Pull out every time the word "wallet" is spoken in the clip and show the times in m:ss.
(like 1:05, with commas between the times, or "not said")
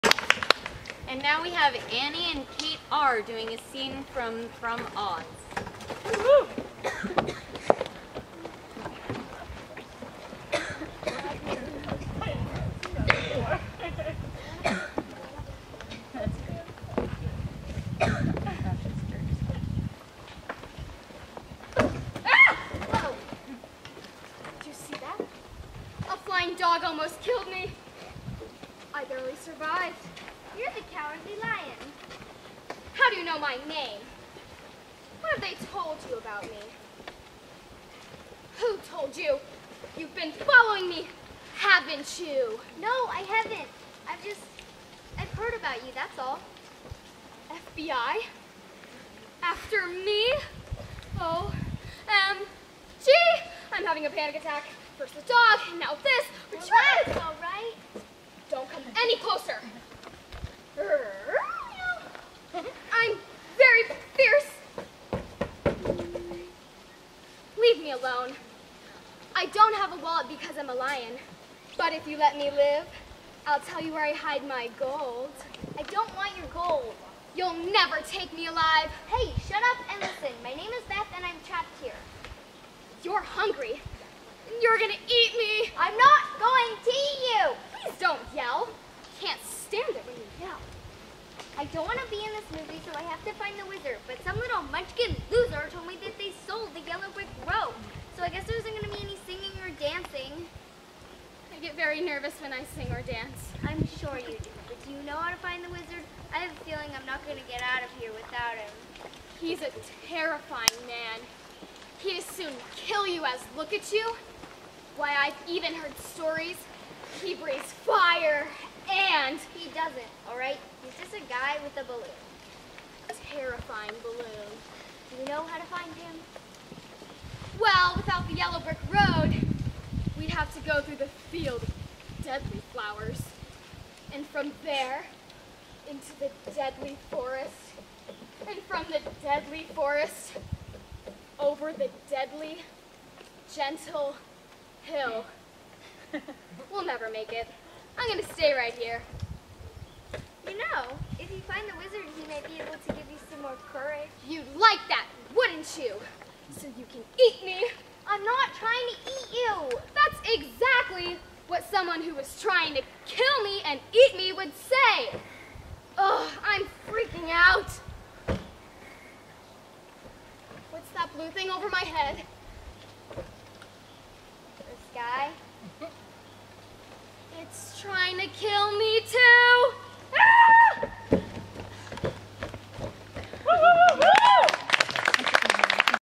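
1:10.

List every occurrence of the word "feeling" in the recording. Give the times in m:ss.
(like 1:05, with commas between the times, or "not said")
1:46.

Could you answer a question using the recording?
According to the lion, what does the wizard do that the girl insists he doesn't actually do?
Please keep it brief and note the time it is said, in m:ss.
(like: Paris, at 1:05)
breathes fire, at 1:57.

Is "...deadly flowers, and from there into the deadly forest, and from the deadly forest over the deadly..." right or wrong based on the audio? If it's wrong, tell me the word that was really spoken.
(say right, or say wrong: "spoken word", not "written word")
right.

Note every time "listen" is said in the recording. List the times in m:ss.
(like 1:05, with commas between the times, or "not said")
1:20.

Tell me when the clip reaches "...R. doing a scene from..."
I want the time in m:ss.
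0:02.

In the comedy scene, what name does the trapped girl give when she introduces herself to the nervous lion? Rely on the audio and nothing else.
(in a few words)
Beth.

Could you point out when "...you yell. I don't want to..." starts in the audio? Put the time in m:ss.
1:30.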